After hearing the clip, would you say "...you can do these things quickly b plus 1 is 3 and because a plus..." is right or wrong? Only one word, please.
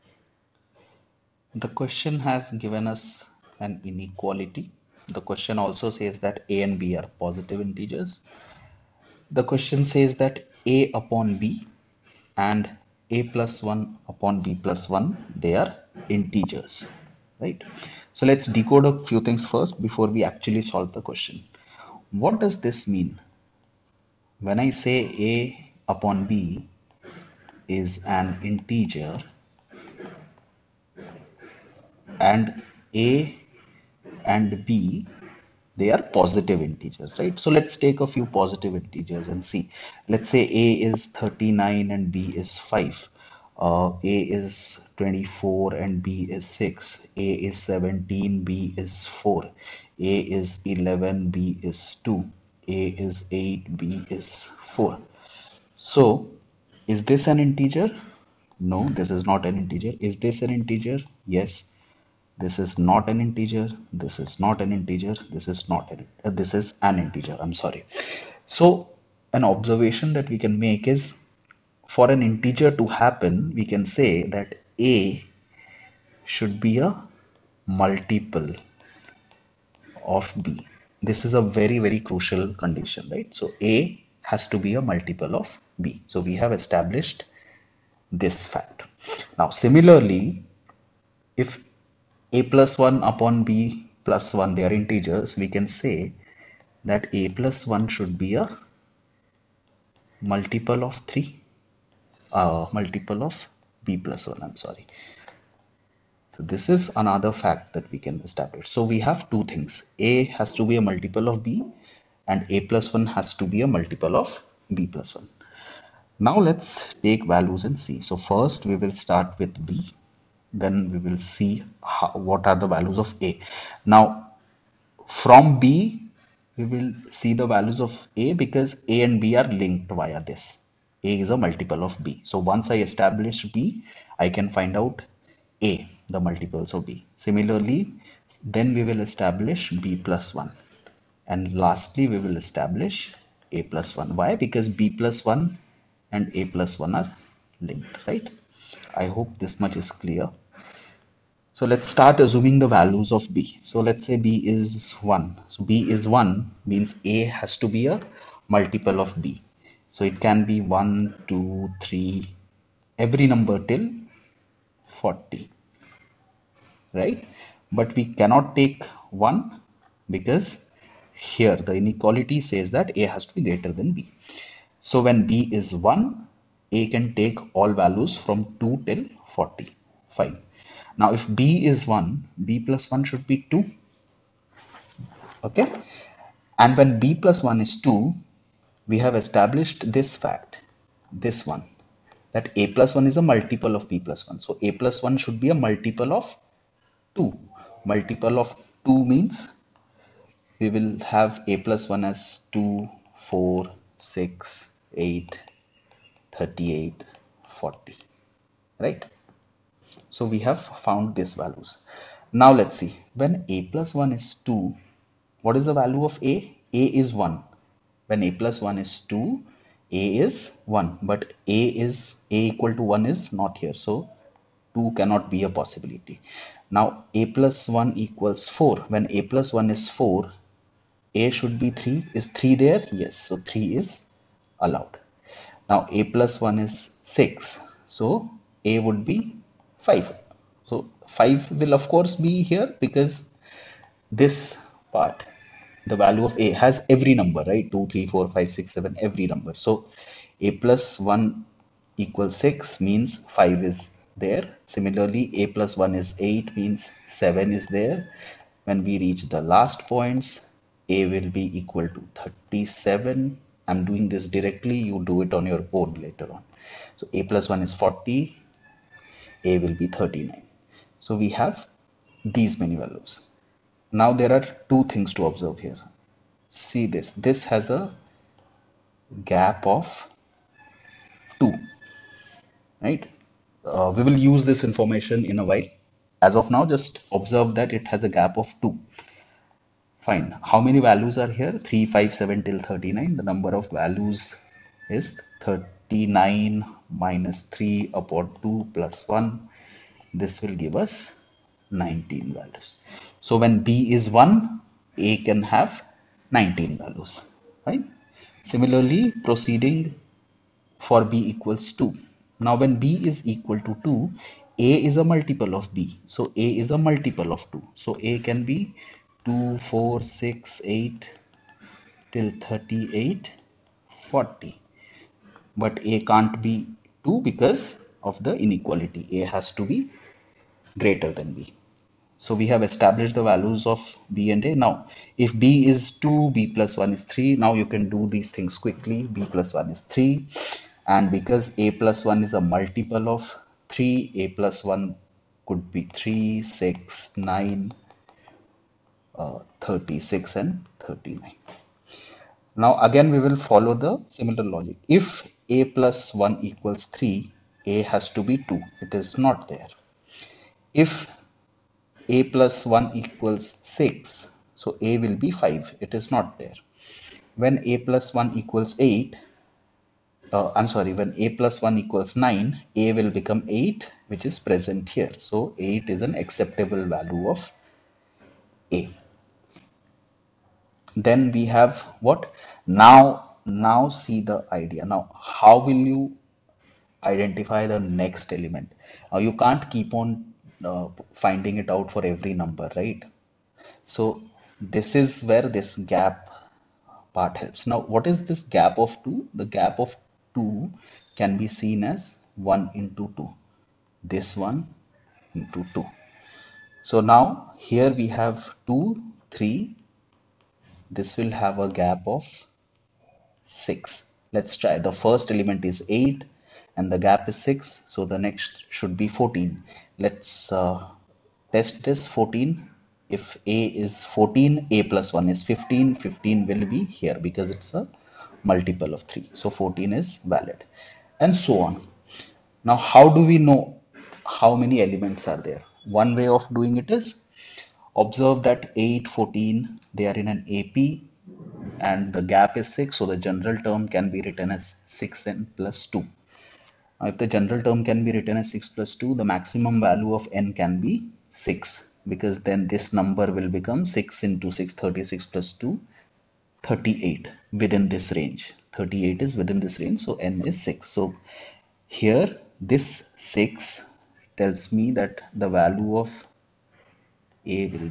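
right.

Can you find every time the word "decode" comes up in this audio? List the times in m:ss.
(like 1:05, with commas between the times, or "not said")
0:18.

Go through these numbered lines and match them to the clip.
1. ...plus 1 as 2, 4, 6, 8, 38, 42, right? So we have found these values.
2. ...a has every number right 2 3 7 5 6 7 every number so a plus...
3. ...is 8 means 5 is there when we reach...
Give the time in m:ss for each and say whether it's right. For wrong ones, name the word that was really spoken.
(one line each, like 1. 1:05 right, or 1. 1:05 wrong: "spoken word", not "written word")
1. 3:21 wrong: "40", not "42"
2. 4:06 wrong: "4", not "7"
3. 4:16 wrong: "7", not "5".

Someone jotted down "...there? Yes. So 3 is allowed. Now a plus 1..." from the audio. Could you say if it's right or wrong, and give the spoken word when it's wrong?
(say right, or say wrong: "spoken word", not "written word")
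right.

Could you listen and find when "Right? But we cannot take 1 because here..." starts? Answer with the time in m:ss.
2:46.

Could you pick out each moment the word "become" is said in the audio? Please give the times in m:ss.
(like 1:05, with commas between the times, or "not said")
6:13, 7:33.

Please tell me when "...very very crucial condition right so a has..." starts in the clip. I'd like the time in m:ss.
1:21.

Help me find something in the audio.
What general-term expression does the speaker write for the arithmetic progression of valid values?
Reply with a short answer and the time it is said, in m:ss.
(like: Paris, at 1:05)
6n + 2, at 7:24.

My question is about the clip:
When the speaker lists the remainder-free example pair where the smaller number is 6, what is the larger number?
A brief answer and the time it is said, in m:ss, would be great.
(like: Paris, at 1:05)
24, at 0:44.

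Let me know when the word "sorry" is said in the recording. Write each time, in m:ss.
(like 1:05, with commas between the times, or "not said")
1:07, 1:44, 6:10.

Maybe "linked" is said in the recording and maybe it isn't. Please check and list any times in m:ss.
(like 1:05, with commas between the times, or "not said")
2:09, 2:27.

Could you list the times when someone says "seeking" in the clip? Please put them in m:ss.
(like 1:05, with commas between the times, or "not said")
not said.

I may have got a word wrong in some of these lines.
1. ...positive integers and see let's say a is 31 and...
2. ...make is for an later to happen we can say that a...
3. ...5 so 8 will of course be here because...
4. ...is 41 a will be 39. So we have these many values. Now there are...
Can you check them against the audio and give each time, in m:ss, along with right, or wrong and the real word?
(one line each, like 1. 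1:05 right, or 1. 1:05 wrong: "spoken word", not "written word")
1. 0:38 wrong: "39", not "31"
2. 1:10 wrong: "integer", not "later"
3. 3:59 wrong: "5", not "8"
4. 4:27 wrong: "40", not "41".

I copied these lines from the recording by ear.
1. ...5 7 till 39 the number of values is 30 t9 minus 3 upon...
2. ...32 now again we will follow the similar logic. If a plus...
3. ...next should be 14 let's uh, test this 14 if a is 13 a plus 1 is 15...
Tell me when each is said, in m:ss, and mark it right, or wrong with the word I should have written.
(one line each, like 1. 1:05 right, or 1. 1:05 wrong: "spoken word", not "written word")
1. 4:51 right
2. 5:50 wrong: "39", not "32"
3. 6:58 wrong: "14", not "13".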